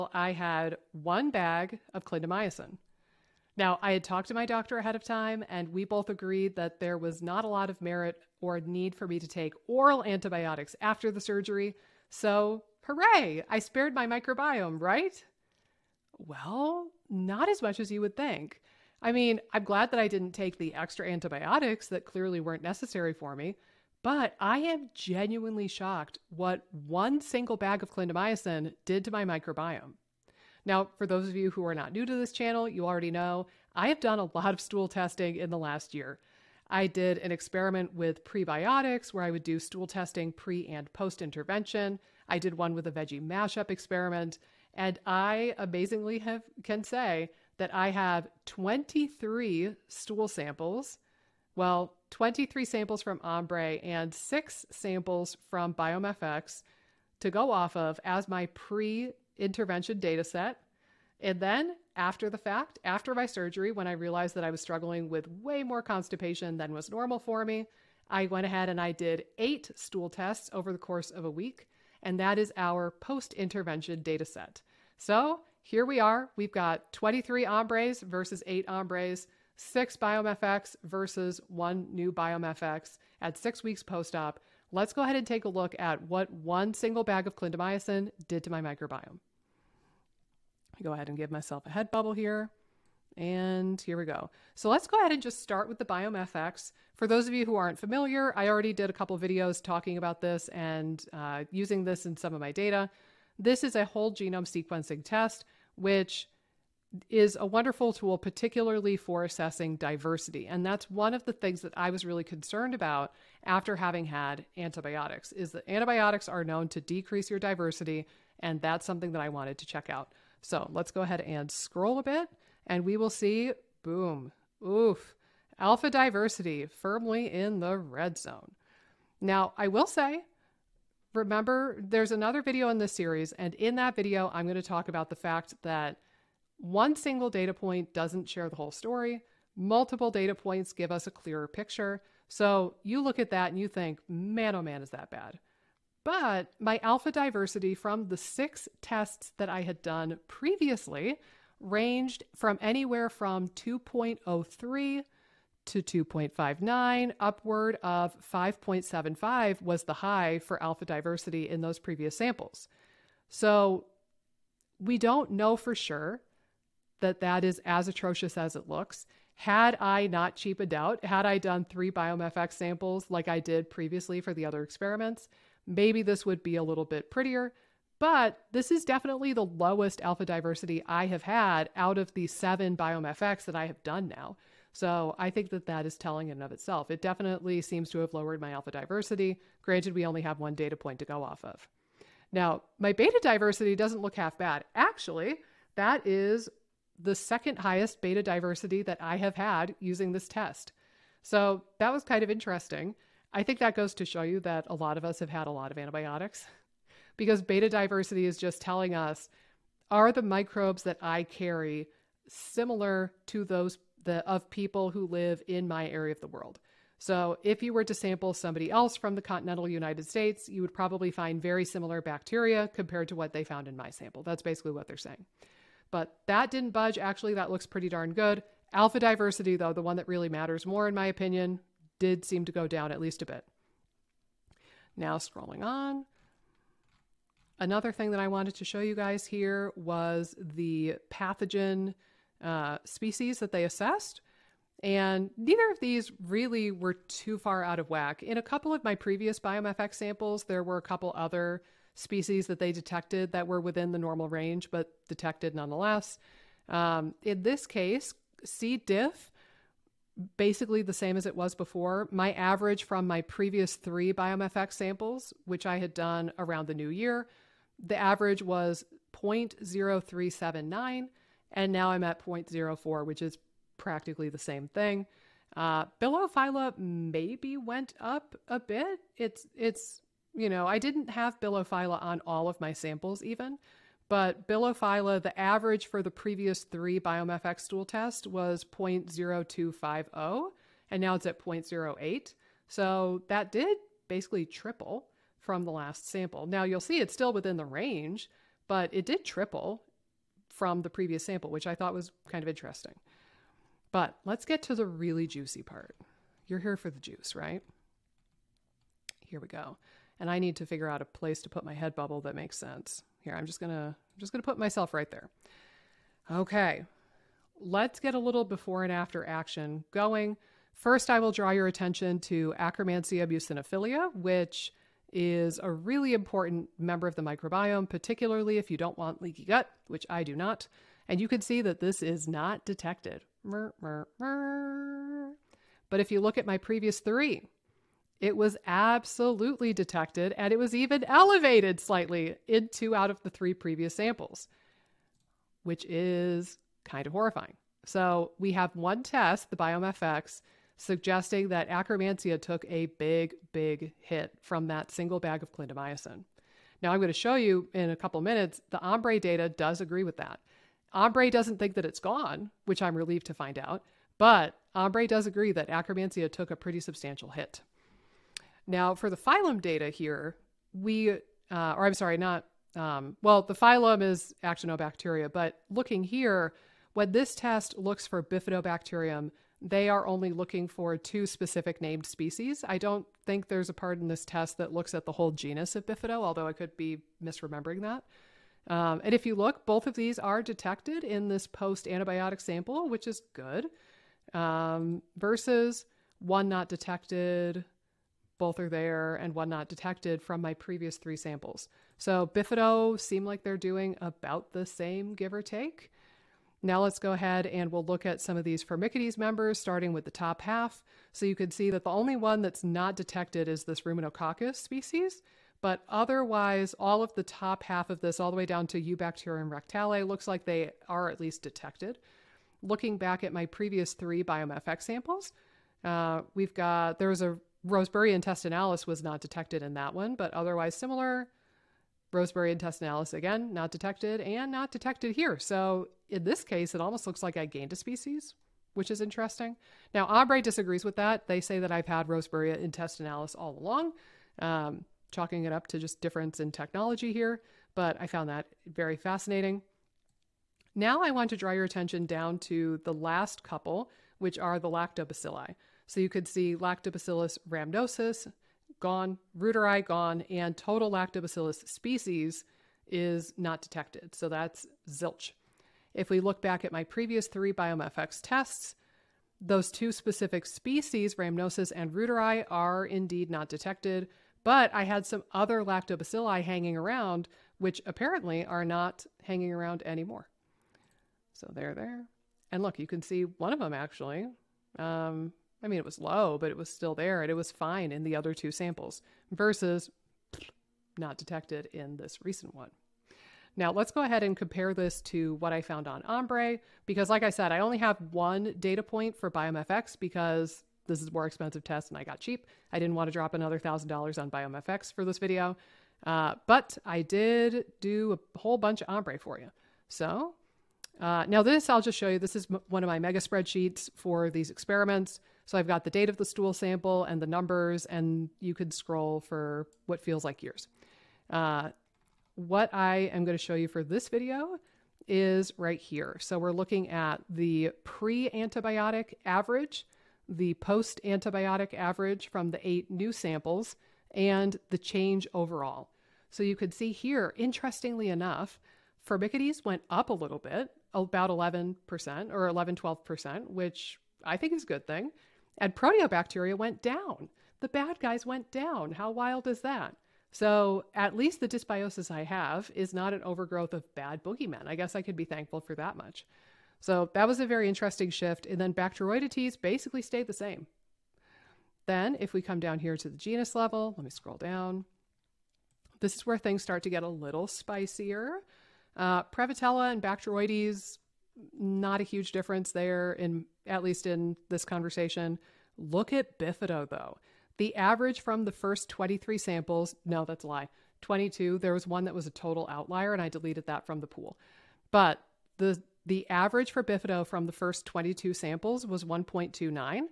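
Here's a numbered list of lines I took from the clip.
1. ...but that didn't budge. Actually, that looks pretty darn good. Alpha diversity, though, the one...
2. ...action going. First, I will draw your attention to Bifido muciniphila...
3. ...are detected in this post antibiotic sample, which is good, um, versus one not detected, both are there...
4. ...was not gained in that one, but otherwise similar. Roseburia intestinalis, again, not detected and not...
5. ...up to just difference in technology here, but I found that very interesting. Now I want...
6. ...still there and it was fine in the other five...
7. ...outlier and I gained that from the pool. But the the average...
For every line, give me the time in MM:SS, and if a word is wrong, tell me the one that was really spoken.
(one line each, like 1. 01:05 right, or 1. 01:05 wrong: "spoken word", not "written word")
1. 03:45 right
2. 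05:19 wrong: "Akkermansia", not "Bifido"
3. 06:30 right
4. 07:08 wrong: "detected", not "gained"
5. 07:25 wrong: "fascinating", not "interesting"
6. 08:06 wrong: "two", not "five"
7. 09:42 wrong: "deleted", not "gained".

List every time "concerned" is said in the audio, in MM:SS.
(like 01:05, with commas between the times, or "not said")
01:52.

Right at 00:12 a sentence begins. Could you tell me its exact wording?
So, hooray, I spared my microbiome, right?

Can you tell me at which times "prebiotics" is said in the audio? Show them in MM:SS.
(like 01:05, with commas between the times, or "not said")
00:38.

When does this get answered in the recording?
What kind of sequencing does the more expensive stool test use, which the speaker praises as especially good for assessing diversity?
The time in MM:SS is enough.
01:43.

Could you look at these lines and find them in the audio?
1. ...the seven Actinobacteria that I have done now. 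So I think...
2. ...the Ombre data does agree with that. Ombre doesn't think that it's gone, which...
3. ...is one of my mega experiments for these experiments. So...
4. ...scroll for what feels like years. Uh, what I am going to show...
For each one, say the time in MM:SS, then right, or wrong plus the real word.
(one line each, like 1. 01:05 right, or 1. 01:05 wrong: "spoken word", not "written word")
1. 03:02 wrong: "BiomeFX", not "Actinobacteria"
2. 05:58 right
3. 08:32 wrong: "spreadsheets", not "experiments"
4. 08:38 right.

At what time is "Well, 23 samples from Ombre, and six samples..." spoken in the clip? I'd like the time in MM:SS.
00:51.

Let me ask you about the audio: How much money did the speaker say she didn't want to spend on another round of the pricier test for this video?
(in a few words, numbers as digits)
$1,000.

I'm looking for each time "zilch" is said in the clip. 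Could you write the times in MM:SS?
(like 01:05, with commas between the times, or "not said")
07:44.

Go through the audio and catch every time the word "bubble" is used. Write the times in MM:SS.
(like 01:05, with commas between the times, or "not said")
01:31, 05:11.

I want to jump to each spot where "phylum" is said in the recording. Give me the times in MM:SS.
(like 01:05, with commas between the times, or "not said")
06:09, 06:13.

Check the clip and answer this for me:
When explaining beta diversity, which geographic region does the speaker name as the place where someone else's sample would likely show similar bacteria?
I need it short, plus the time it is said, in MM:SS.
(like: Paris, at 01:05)
Continental United States, at 03:39.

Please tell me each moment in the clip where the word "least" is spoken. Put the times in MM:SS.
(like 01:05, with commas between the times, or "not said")
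03:52, 07:01, 09:11, 09:33.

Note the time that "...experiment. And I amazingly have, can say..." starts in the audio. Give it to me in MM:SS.
00:43.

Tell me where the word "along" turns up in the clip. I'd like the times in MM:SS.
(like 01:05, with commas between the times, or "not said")
07:23.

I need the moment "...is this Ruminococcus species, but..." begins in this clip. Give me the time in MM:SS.
06:53.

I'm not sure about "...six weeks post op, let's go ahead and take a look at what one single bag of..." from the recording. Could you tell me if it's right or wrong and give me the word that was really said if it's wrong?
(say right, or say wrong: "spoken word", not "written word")
right.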